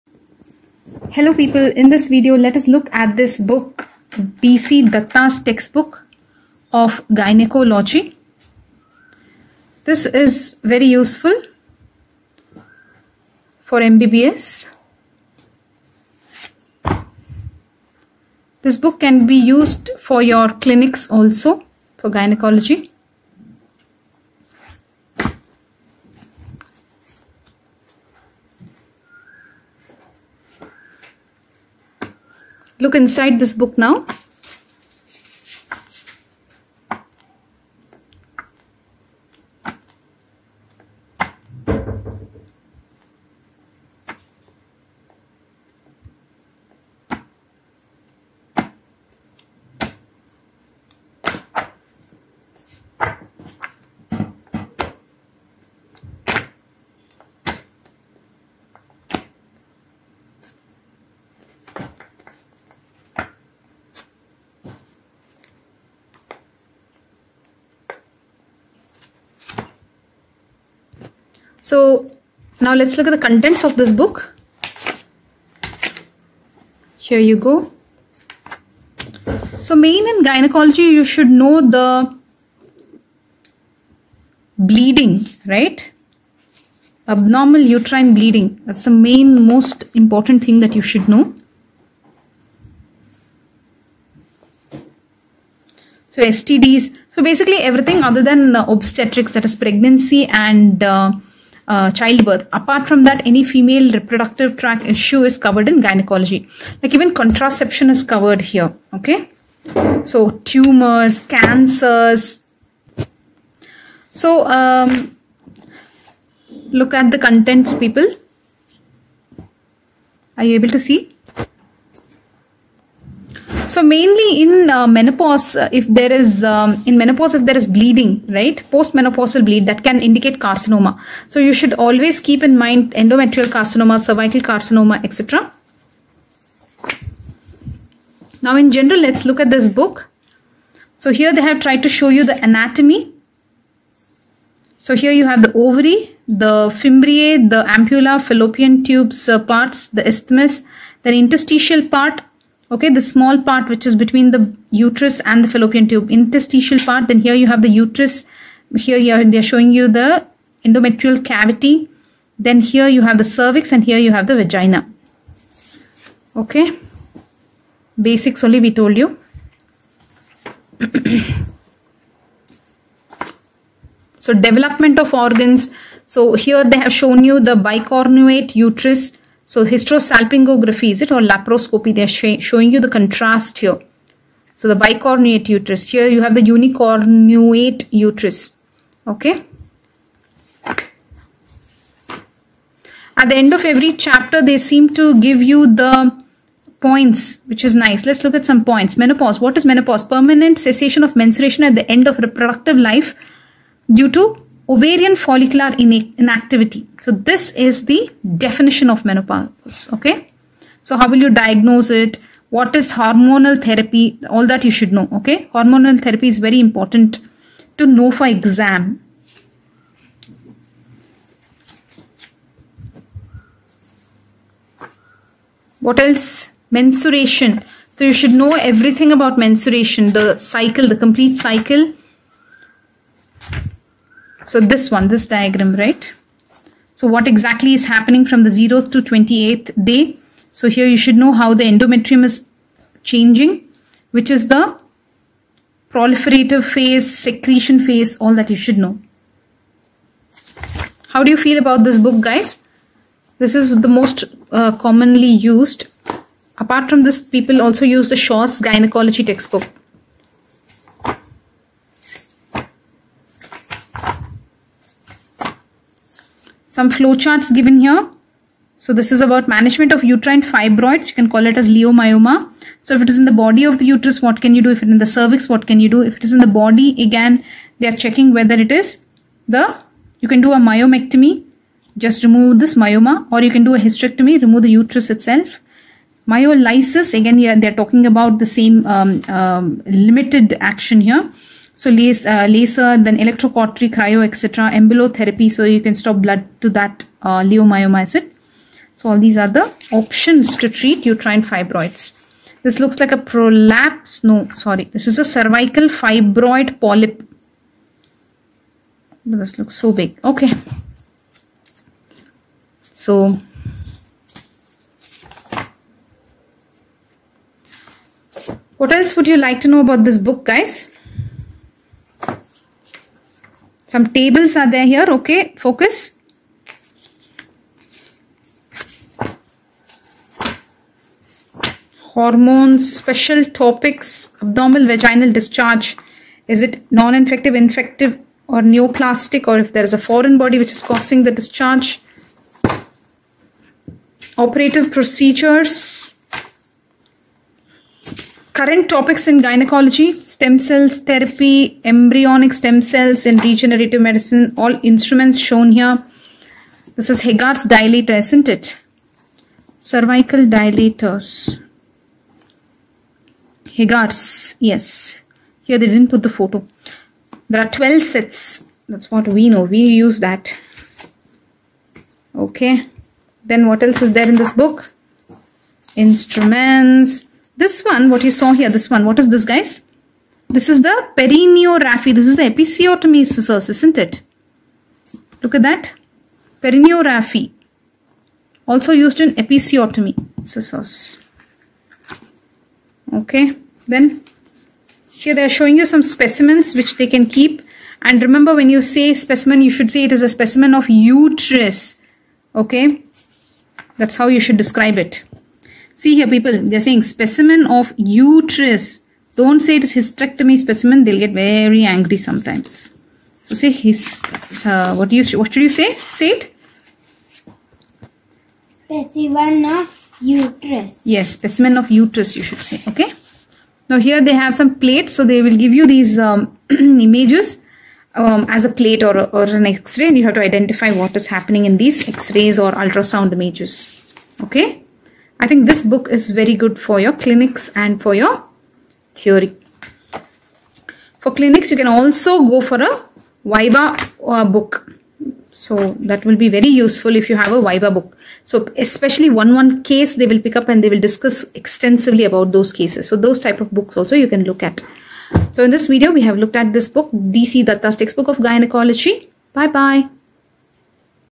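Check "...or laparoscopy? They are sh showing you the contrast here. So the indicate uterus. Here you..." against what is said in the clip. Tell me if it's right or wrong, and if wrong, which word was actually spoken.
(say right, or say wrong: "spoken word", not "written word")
wrong: "bicornuate", not "indicate".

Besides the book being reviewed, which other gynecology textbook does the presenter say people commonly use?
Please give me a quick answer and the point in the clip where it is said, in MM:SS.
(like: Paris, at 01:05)
Shaw's gynecology textbook, at 04:18.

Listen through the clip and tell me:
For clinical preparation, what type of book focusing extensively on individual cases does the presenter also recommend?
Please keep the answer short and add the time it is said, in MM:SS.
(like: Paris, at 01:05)
Viva book, at 07:23.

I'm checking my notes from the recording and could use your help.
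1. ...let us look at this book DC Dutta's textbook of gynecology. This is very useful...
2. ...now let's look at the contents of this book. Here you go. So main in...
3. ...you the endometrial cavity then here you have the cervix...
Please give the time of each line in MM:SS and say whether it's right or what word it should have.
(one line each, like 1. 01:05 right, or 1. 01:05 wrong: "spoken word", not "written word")
1. 00:02 right
2. 01:12 right
3. 02:39 right.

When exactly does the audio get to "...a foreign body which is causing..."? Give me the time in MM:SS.
05:39.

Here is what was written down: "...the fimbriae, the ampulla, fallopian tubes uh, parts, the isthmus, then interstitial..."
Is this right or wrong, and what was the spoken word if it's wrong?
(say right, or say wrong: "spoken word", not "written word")
right.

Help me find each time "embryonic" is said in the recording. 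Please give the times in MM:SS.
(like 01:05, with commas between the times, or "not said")
05:51.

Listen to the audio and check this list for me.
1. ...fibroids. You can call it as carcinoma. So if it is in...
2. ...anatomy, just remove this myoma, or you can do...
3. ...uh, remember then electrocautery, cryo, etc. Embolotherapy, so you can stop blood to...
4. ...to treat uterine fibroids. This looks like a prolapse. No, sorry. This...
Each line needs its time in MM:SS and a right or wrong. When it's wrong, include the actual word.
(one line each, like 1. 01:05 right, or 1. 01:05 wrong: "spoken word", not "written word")
1. 04:30 wrong: "leiomyoma", not "carcinoma"
2. 04:40 wrong: "myomectomy", not "anatomy"
3. 04:52 wrong: "laser", not "remember"
4. 05:00 right.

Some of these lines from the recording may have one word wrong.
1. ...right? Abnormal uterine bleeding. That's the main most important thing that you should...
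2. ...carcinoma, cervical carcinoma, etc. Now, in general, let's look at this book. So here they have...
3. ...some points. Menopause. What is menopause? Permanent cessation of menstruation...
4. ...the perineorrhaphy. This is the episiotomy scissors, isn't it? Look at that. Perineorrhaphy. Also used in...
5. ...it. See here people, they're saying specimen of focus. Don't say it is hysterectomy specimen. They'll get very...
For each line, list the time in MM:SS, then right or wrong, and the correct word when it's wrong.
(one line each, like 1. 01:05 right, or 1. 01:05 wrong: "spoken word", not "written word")
1. 01:25 right
2. 02:13 right
3. 03:18 right
4. 06:20 right
5. 06:44 wrong: "uterus", not "focus".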